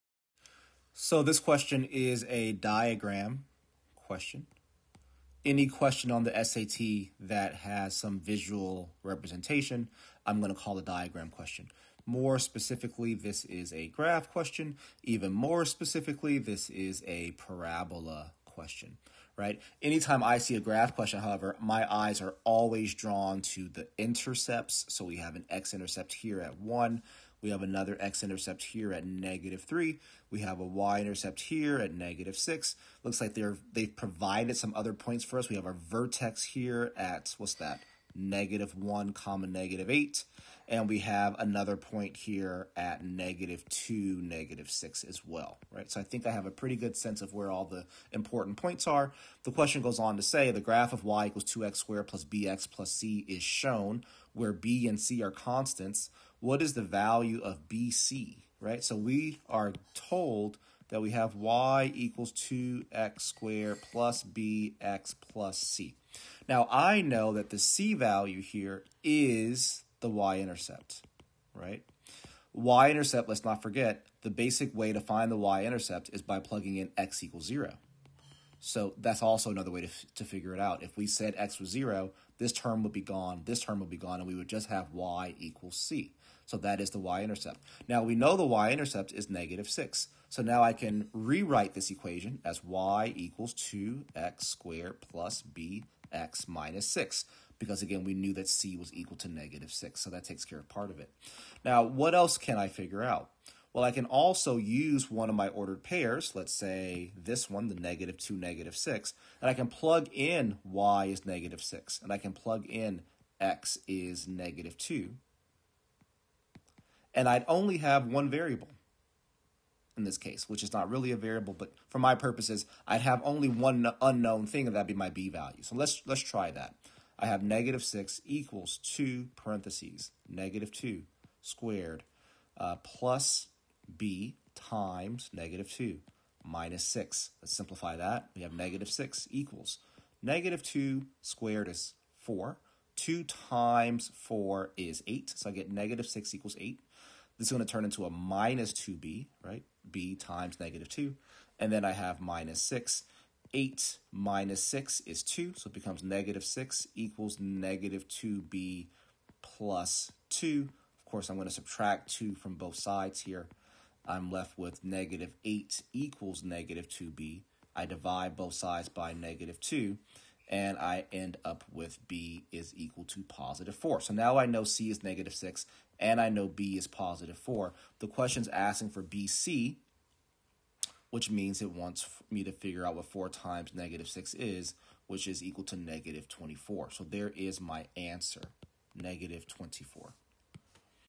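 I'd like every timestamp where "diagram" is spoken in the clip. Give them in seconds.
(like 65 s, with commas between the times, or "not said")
2 s, 10 s.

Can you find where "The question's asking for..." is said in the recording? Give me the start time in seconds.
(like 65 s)
177 s.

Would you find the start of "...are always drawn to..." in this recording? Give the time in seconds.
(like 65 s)
22 s.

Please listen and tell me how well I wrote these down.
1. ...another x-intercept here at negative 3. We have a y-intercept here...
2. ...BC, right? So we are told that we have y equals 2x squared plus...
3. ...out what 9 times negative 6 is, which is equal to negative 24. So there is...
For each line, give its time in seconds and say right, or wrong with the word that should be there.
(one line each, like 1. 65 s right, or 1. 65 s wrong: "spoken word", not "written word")
1. 27 s right
2. 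57 s right
3. 182 s wrong: "4", not "9".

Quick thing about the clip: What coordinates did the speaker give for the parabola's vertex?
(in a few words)
(-1, -8).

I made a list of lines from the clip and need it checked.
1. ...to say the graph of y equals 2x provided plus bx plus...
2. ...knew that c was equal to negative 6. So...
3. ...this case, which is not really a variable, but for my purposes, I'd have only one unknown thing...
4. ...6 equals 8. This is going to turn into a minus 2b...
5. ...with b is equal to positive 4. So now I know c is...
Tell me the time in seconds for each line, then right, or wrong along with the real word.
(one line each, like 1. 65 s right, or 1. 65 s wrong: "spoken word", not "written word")
1. 50 s wrong: "squared", not "provided"
2. 98 s right
3. 120 s right
4. 146 s right
5. 171 s right.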